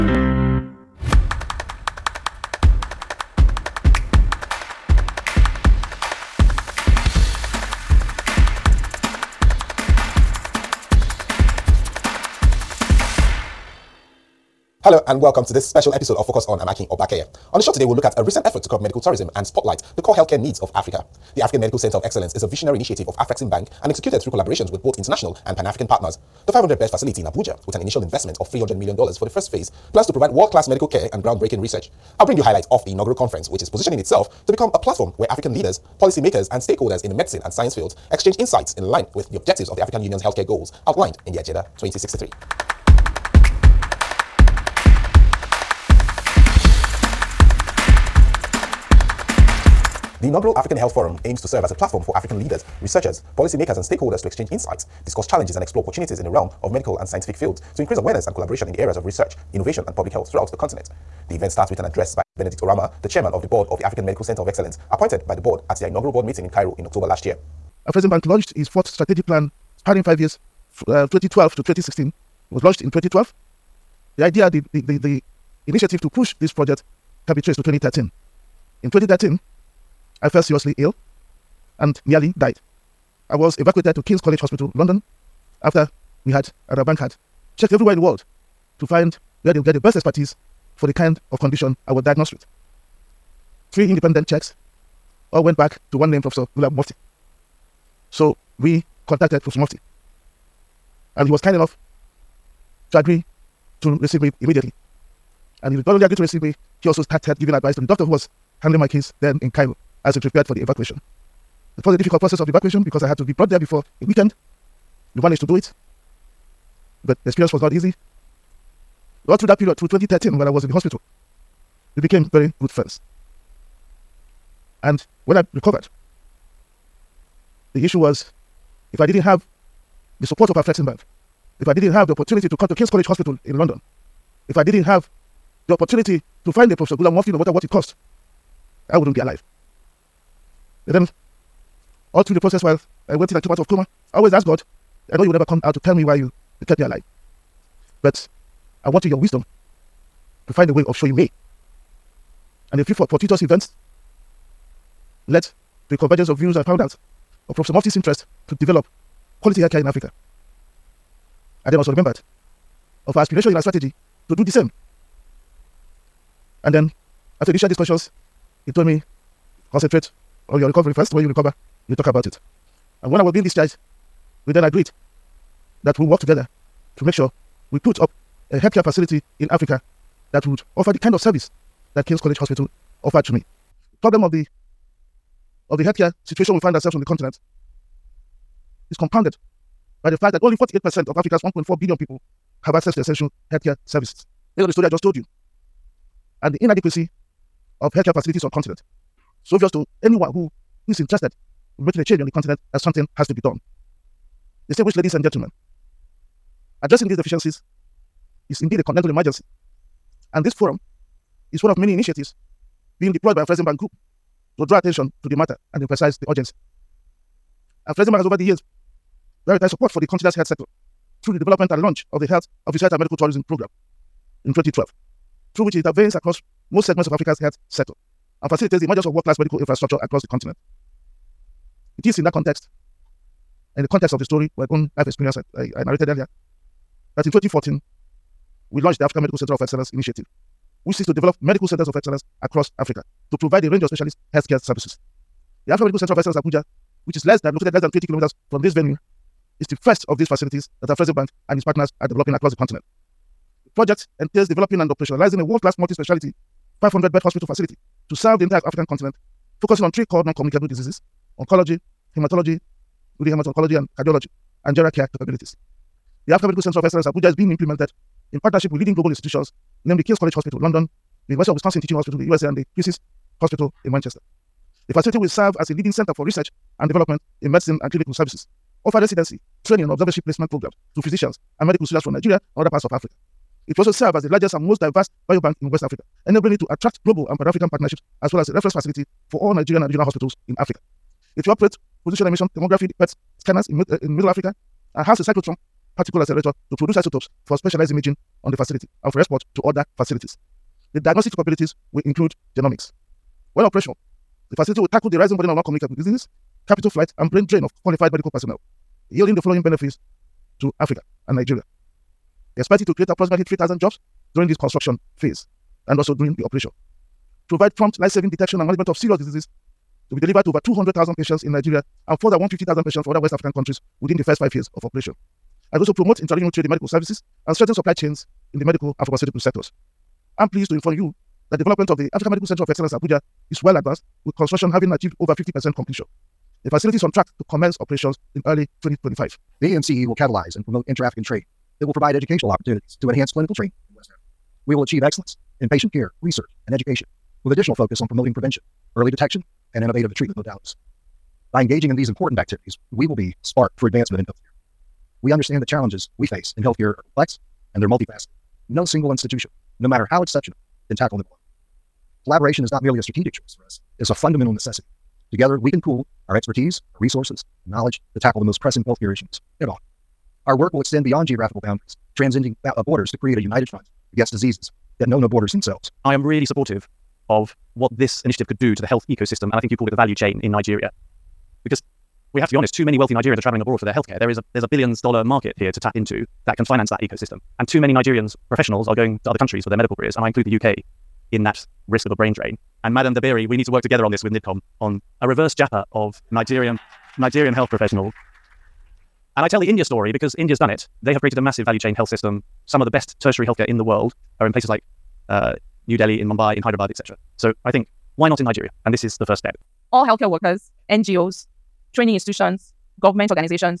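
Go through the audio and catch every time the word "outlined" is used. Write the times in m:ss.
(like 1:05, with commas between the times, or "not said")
0:40.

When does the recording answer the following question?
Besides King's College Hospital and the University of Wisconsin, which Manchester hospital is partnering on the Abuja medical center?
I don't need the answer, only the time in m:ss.
4:32.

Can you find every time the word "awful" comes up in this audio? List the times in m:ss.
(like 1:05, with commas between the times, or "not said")
not said.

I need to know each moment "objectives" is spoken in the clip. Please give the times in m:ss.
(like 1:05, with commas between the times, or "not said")
0:39.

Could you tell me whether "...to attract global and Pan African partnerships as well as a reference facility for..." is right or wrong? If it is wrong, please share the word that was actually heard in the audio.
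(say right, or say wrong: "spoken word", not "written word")
right.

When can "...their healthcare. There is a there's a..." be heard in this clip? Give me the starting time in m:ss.
6:23.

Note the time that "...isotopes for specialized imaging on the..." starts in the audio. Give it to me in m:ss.
4:56.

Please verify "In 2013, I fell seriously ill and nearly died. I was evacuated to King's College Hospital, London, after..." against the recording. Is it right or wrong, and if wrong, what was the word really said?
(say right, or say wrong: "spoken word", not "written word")
right.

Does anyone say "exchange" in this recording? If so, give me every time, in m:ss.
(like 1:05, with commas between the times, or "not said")
0:38, 0:54.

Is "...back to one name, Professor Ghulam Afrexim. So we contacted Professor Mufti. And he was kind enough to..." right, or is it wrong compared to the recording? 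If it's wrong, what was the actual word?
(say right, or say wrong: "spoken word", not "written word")
wrong: "Mufti", not "Afrexim".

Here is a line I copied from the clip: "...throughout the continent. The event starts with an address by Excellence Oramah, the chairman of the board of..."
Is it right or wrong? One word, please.
wrong.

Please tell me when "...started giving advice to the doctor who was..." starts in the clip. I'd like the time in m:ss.
1:47.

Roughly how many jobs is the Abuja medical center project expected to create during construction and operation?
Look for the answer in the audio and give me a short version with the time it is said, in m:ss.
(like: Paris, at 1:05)
3,000, at 5:13.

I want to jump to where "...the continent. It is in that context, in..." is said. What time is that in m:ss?
3:50.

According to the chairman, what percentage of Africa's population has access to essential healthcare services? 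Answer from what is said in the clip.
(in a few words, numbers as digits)
48%.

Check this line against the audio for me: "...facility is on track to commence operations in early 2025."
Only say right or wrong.
right.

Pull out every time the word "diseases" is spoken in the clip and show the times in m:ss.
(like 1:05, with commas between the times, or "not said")
4:20, 5:05, 5:19, 6:14.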